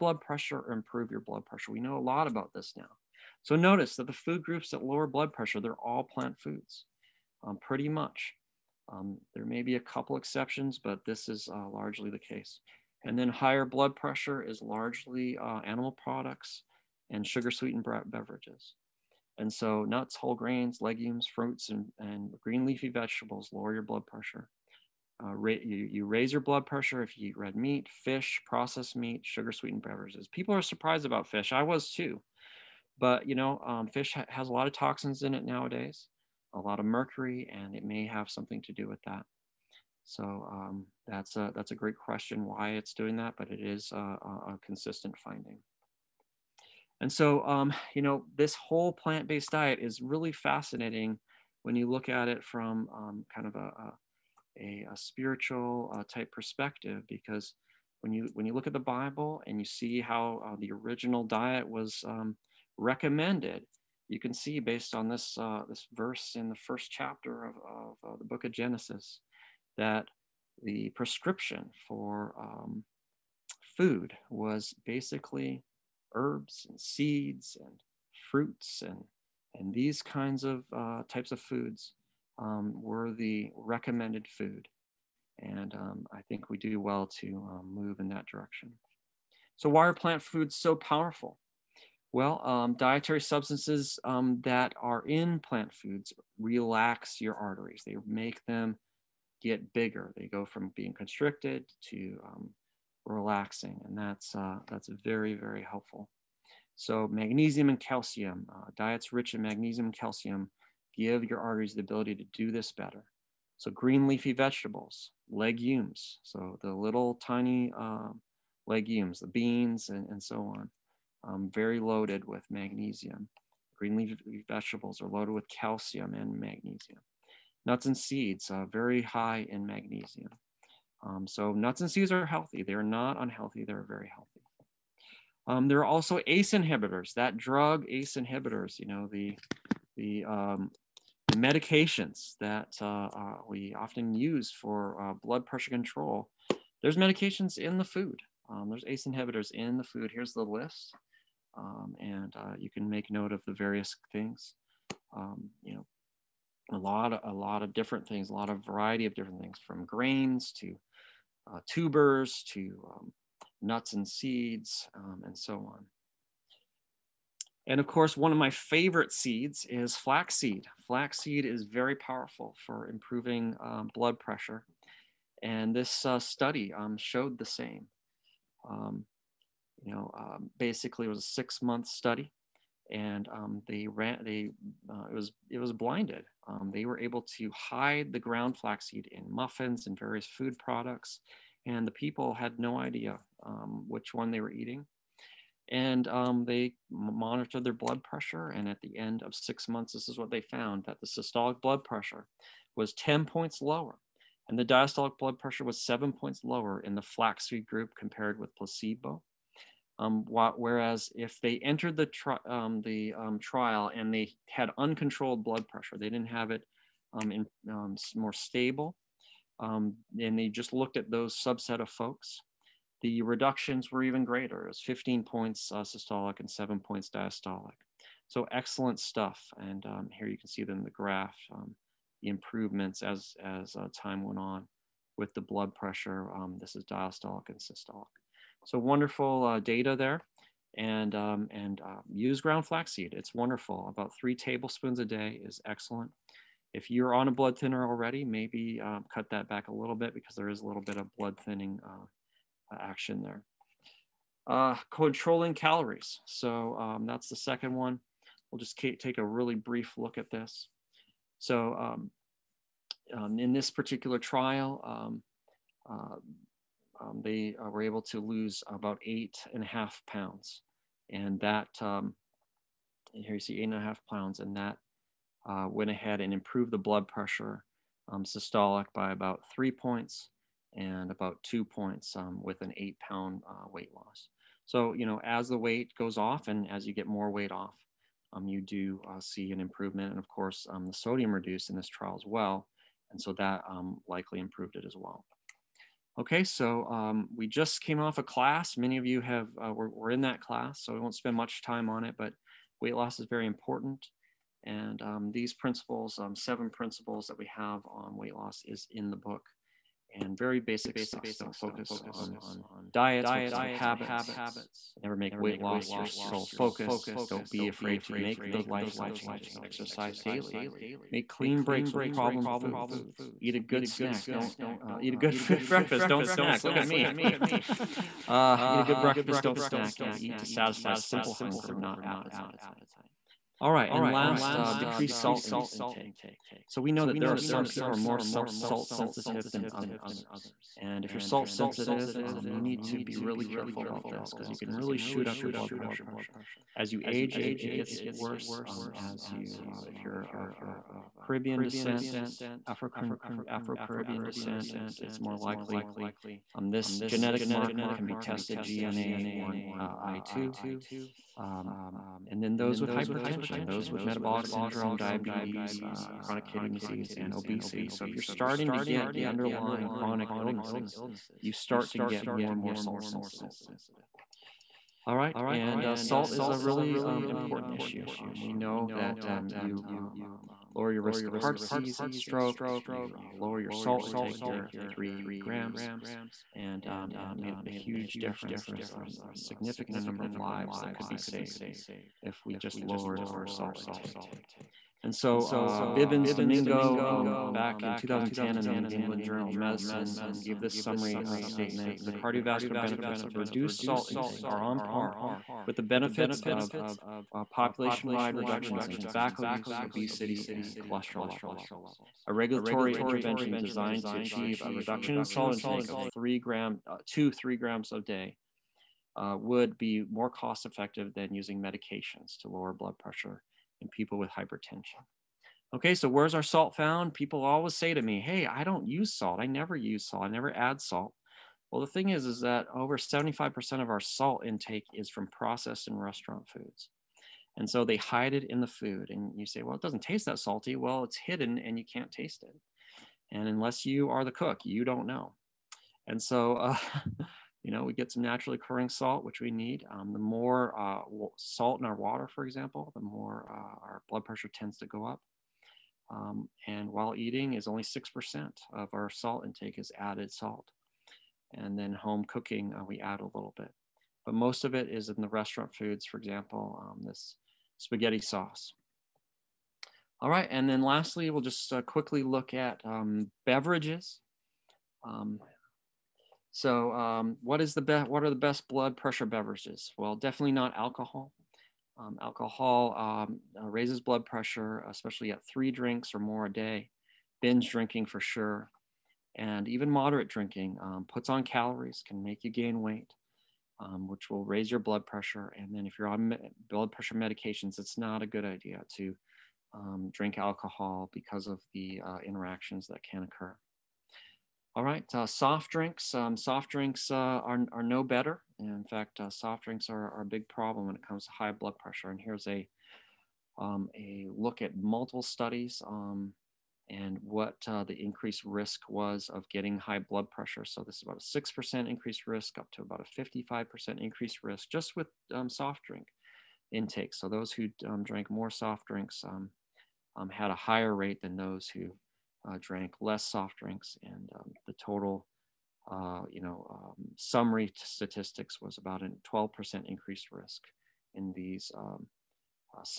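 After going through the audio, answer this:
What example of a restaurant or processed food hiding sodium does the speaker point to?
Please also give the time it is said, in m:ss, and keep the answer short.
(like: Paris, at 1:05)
Spaghetti sauce, at 7:47.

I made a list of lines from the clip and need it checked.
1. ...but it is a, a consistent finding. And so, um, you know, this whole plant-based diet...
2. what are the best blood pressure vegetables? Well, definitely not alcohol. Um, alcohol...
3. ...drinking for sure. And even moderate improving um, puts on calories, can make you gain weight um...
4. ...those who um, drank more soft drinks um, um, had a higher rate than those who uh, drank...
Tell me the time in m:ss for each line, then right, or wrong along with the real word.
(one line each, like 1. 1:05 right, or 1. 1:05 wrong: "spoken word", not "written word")
1. 0:43 right
2. 7:58 wrong: "beverages", not "vegetables"
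3. 8:07 wrong: "drinking", not "improving"
4. 8:47 right.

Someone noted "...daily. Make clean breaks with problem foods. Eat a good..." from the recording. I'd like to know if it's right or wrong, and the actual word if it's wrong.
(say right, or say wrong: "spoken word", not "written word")
right.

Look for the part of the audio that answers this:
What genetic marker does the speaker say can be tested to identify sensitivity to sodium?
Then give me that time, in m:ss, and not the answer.
5:58.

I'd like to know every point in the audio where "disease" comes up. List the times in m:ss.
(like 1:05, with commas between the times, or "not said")
6:06, 6:21.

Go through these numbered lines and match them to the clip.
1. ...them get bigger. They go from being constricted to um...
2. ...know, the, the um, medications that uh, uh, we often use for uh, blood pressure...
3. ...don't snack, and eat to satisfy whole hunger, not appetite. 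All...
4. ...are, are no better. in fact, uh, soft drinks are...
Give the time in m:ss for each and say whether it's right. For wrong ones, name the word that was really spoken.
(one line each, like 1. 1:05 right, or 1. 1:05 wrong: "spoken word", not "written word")
1. 1:38 right
2. 2:18 right
3. 5:29 wrong: "simple", not "whole"
4. 8:27 right.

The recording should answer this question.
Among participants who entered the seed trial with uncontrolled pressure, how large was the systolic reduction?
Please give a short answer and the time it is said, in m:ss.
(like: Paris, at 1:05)
15 points, at 3:44.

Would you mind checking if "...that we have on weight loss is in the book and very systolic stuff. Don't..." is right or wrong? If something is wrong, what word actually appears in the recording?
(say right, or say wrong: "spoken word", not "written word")
wrong: "basic", not "systolic".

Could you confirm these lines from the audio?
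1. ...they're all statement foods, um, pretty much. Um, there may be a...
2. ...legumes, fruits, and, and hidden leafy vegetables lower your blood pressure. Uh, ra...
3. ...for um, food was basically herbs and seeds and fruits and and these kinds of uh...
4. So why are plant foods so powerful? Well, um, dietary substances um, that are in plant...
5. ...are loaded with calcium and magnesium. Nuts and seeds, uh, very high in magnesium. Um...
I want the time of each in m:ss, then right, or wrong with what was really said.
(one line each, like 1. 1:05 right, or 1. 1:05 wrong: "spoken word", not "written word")
1. 0:05 wrong: "plant", not "statement"
2. 0:20 wrong: "green", not "hidden"
3. 1:11 right
4. 1:29 right
5. 2:05 right.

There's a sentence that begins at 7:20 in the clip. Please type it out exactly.
Well, it's hidden and you can't taste it.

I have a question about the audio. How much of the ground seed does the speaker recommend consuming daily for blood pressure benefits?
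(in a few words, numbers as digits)
3 tablespoons.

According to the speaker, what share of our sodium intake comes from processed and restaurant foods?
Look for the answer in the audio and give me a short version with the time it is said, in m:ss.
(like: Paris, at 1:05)
Over 75%, at 7:12.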